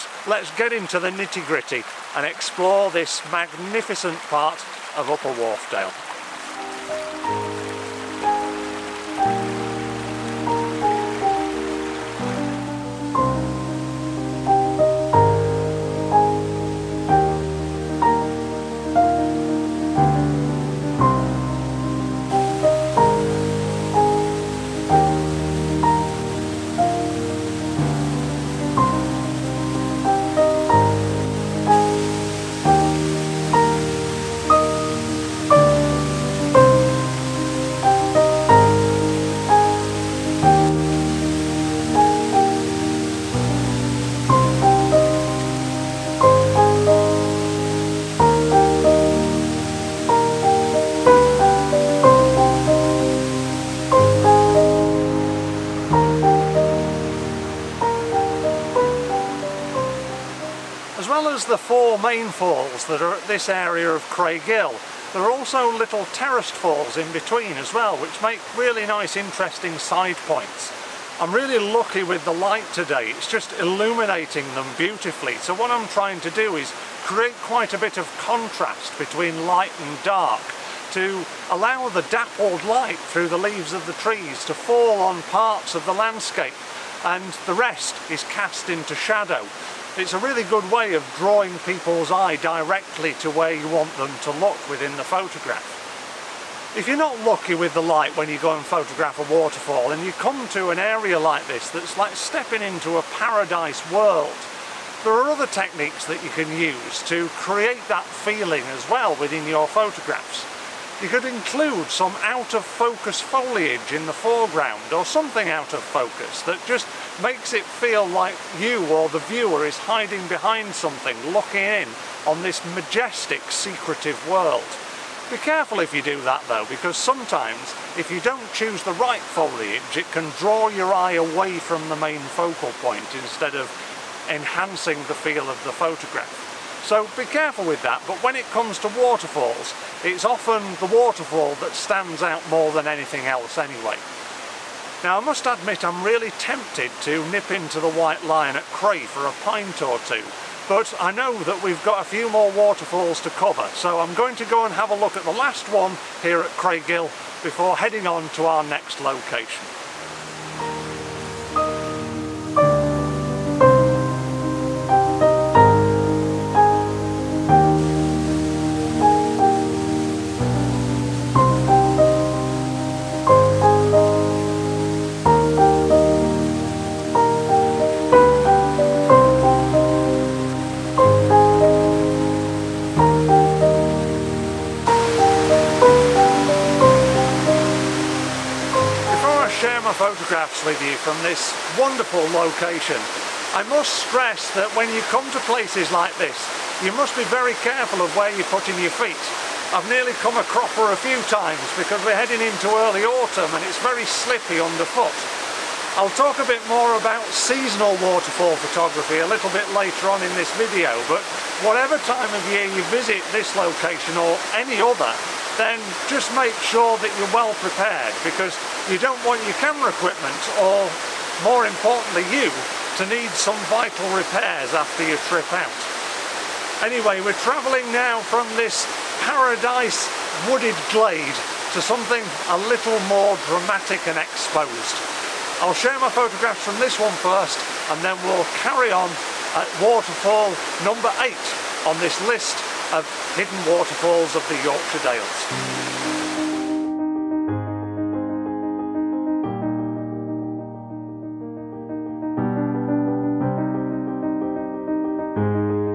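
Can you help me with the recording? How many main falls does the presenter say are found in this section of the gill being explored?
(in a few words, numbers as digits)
4.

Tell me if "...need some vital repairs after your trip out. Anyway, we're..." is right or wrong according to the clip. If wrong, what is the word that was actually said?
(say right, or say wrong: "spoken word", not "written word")
right.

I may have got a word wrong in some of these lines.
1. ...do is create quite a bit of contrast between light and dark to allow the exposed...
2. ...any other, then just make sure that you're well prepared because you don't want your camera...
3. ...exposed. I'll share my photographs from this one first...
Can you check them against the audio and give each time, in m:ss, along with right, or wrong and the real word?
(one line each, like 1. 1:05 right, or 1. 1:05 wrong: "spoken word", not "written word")
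1. 1:16 wrong: "dappled", not "exposed"
2. 3:34 right
3. 3:54 right.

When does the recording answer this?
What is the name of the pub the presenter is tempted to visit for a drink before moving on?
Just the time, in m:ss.
2:27.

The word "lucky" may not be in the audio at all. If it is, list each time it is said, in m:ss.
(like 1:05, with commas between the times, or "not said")
1:11, 1:37.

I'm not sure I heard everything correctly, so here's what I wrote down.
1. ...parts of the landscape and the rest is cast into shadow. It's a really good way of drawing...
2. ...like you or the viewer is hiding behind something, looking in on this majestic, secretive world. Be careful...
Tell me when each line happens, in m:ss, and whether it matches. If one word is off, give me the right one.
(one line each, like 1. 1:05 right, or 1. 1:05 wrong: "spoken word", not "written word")
1. 1:25 right
2. 1:58 right.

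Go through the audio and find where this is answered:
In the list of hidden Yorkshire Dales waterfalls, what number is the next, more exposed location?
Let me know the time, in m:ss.
4:01.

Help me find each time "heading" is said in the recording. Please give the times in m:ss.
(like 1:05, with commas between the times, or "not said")
2:37, 3:22.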